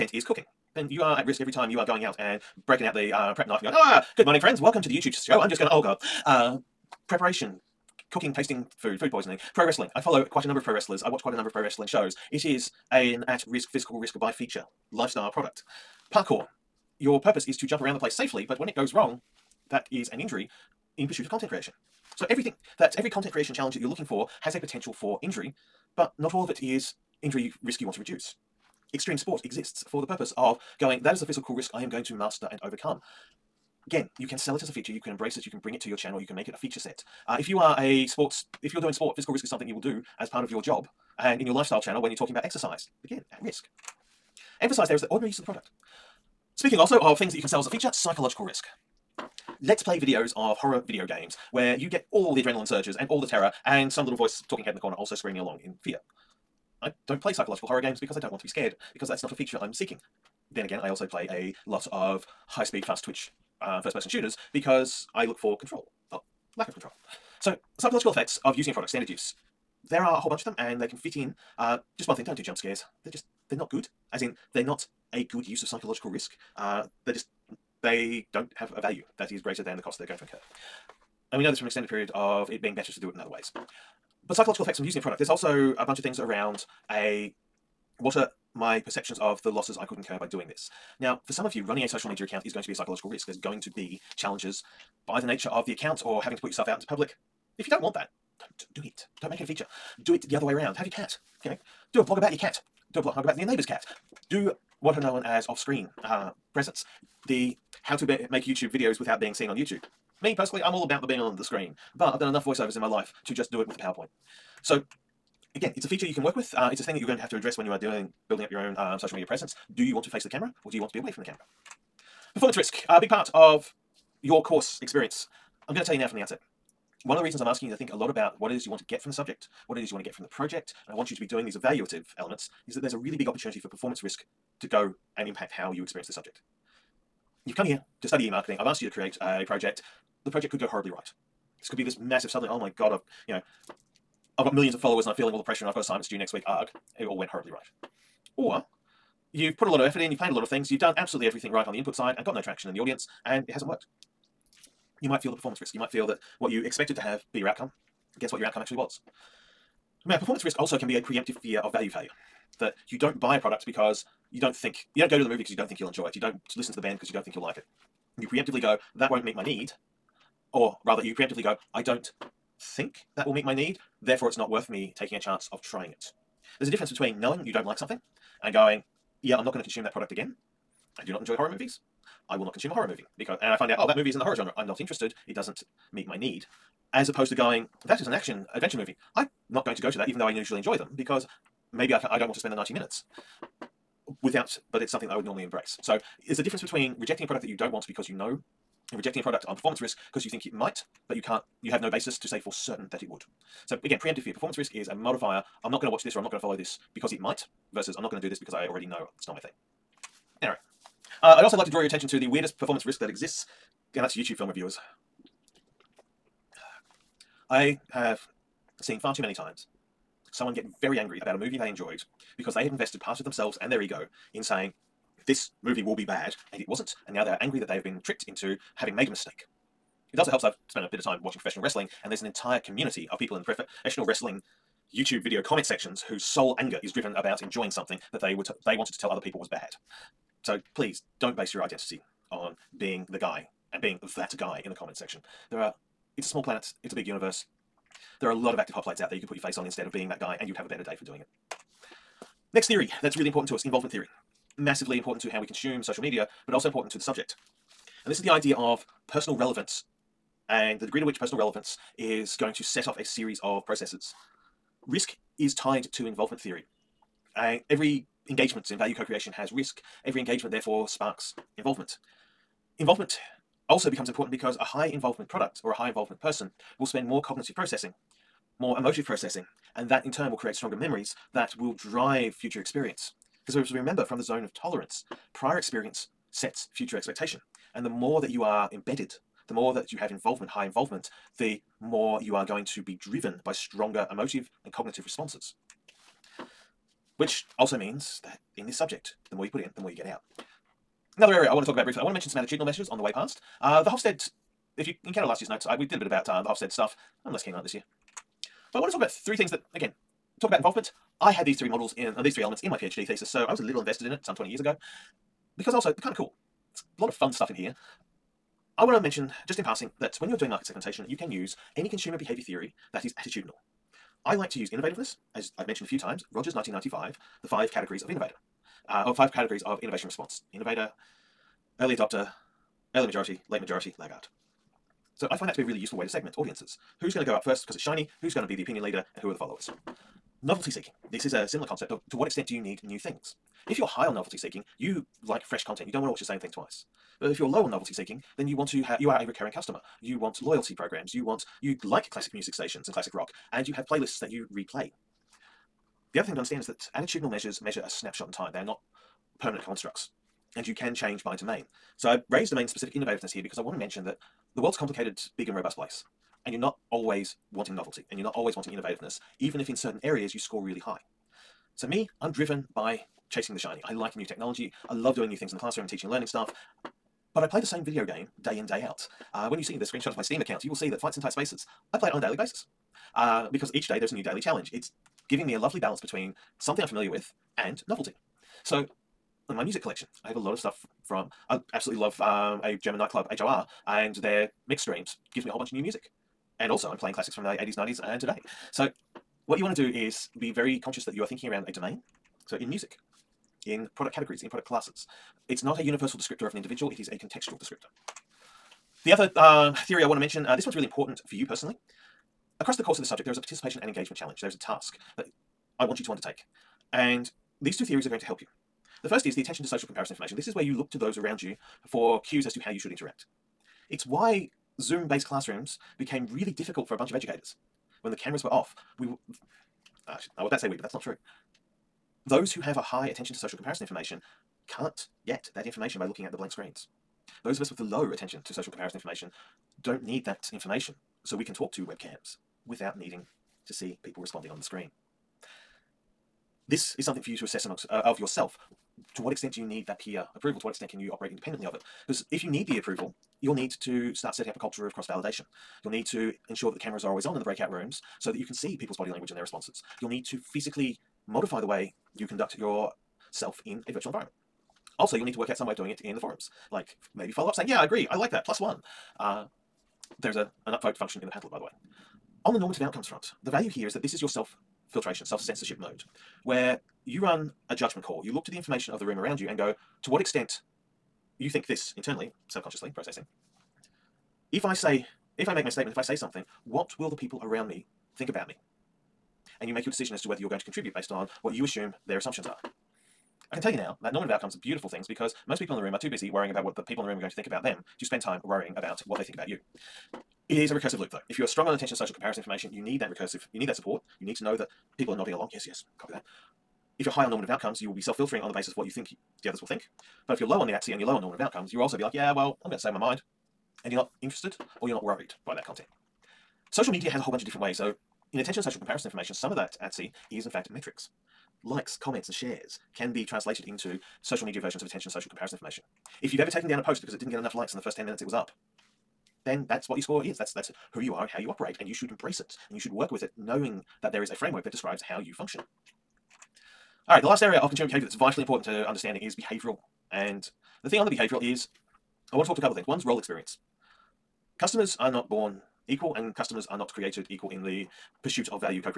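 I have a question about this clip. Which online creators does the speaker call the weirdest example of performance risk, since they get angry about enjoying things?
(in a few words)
YouTube film reviewers.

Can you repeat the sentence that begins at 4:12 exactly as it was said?
Next theory that's really important to us, involvement theory.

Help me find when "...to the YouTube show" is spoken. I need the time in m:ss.
0:04.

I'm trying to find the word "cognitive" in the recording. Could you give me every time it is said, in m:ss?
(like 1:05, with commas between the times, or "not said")
4:37, 4:54.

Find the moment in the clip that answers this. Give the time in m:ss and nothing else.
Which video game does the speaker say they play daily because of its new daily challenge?
6:20.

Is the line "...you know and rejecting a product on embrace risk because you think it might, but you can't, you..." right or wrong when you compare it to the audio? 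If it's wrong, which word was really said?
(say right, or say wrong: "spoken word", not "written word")
wrong: "performance", not "embrace".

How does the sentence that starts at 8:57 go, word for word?
Alright, the last area of consumer behaviour that's vitally important to understanding is behavioural.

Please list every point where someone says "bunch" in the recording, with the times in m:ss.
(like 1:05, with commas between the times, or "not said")
1:10, 1:25, 6:35, 7:06, 8:37.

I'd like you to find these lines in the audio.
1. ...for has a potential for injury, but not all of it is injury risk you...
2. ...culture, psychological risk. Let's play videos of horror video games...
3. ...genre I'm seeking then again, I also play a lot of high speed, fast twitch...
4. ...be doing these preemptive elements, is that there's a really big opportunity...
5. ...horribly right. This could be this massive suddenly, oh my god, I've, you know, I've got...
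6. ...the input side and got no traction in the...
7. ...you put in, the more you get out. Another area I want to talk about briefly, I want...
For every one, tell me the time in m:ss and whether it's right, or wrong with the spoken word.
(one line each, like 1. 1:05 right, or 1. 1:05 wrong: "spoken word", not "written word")
1. 0:24 right
2. 0:47 wrong: "feature", not "culture"
3. 0:59 wrong: "feature", not "genre"
4. 2:11 wrong: "evaluative", not "preemptive"
5. 2:20 right
6. 2:31 right
7. 4:59 right.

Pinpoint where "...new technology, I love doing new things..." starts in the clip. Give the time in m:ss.
6:14.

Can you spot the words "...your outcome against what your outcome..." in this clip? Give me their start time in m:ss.
2:37.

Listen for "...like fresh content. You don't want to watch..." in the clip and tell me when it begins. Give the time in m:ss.
5:45.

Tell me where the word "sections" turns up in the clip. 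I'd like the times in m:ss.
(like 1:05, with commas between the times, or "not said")
3:55, 4:04.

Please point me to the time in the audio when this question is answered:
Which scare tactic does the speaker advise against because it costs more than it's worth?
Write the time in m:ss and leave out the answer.
1:12.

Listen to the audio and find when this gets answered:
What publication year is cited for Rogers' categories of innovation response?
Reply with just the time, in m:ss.
5:26.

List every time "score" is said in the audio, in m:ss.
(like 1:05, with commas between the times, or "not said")
6:10, 8:50.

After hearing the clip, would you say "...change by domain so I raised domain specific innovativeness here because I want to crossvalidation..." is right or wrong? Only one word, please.
wrong.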